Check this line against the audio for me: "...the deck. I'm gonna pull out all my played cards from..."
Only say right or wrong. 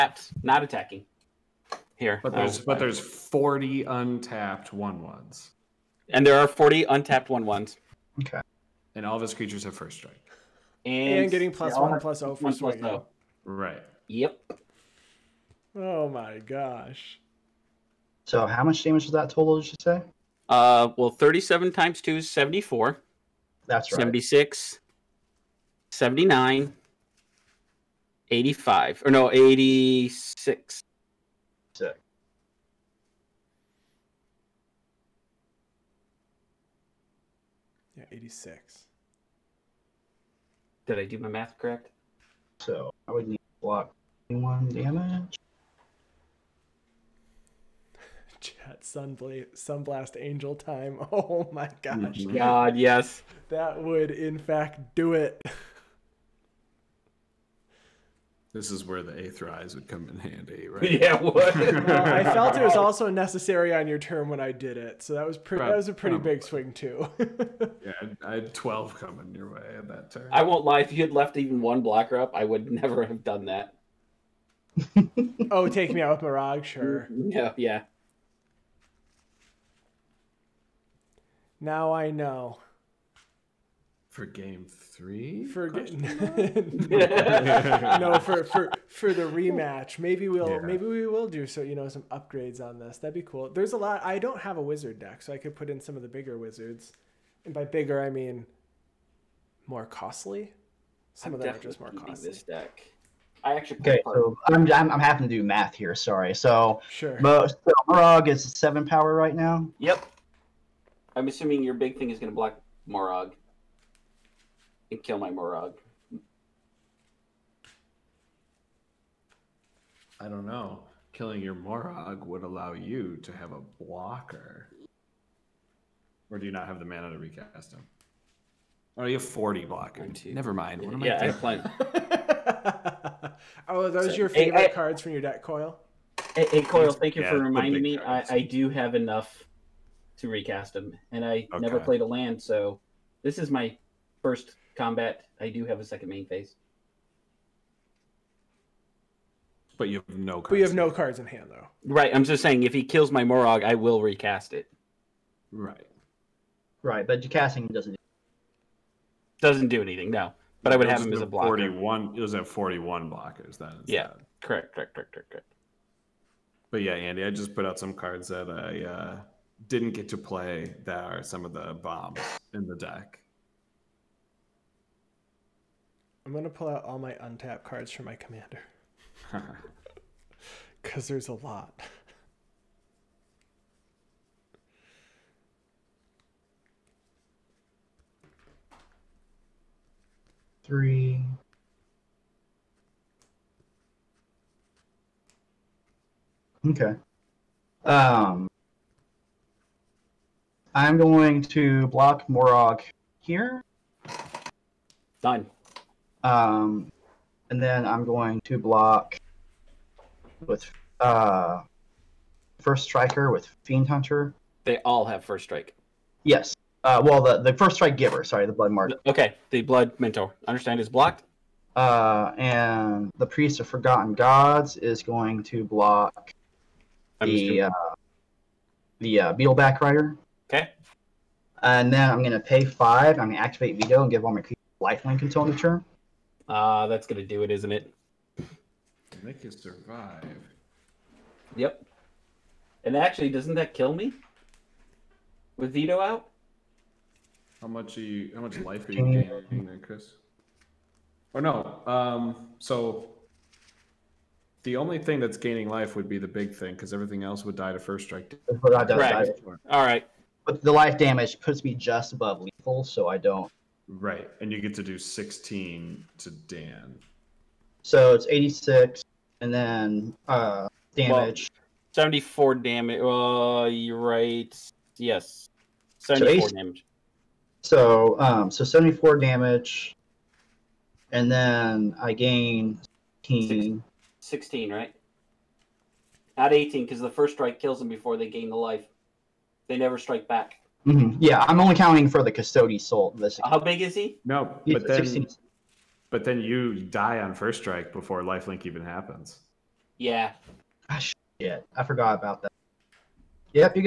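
wrong.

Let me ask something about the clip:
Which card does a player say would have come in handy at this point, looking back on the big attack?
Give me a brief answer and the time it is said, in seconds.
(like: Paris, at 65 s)
Aetherize, at 59 s.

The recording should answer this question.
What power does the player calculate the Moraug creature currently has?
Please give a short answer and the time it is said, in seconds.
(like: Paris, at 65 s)
7, at 108 s.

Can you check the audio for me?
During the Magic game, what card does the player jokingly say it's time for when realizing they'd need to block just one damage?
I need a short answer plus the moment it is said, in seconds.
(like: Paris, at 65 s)
Sunblast Angel, at 49 s.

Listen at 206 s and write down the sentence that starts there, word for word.
Um, and then I'm going to block with uh, first striker with Fiend Hunter.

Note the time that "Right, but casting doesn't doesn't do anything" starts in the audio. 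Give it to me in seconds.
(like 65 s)
156 s.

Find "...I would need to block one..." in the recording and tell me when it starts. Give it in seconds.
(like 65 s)
43 s.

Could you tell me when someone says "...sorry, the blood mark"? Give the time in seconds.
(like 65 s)
218 s.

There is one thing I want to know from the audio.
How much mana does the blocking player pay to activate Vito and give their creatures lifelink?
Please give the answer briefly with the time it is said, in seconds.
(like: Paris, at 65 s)
5, at 232 s.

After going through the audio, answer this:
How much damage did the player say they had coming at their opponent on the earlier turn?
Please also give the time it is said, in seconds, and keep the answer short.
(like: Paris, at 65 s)
12, at 68 s.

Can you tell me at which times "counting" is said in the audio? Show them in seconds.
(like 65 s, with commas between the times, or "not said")
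291 s.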